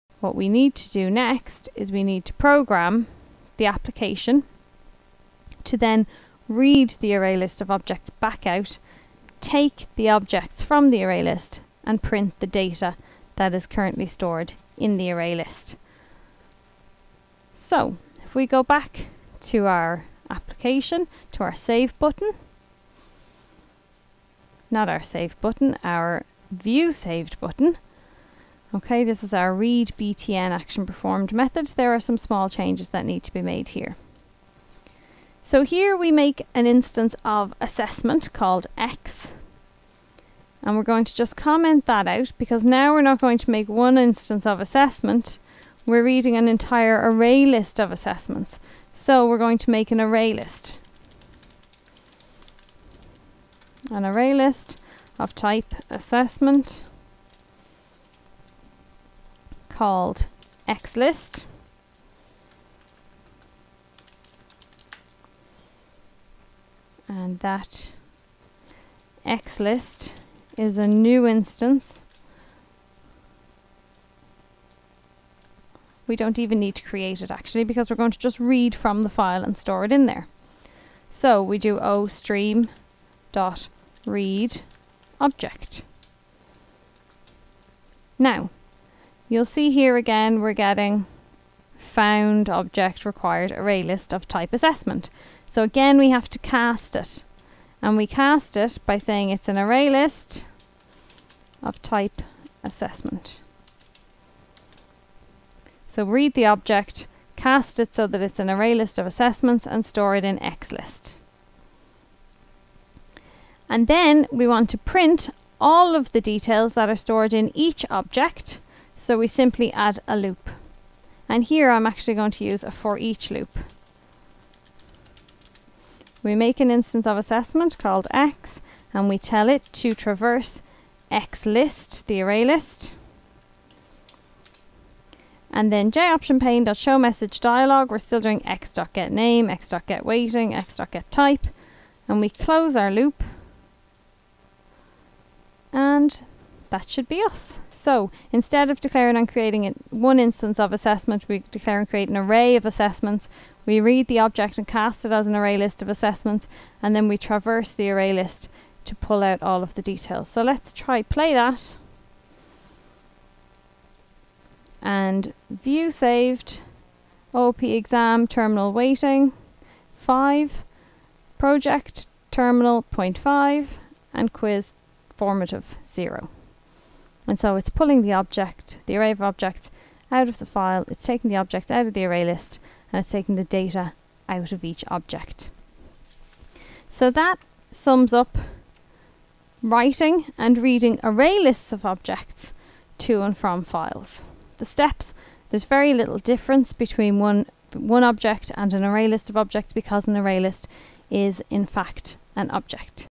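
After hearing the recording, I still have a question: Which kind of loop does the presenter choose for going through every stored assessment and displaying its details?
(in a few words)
for each loop.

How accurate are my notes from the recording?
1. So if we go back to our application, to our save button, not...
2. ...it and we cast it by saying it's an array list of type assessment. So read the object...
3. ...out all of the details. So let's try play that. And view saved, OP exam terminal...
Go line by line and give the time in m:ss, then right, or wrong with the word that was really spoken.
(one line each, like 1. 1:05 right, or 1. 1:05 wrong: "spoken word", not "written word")
1. 0:17 right
2. 1:36 right
3. 2:39 right.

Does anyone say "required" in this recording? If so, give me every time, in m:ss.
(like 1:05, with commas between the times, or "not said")
1:33.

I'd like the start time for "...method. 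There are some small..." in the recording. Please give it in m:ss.
0:31.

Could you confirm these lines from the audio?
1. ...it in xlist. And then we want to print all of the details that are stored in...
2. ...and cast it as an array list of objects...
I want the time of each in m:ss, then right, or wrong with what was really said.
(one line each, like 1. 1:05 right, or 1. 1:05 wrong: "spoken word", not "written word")
1. 1:50 right
2. 2:34 wrong: "assessments", not "objects".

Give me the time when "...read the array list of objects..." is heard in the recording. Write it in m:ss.
0:06.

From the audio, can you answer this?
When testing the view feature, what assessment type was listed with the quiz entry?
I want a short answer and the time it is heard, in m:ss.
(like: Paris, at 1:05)
formative, at 2:55.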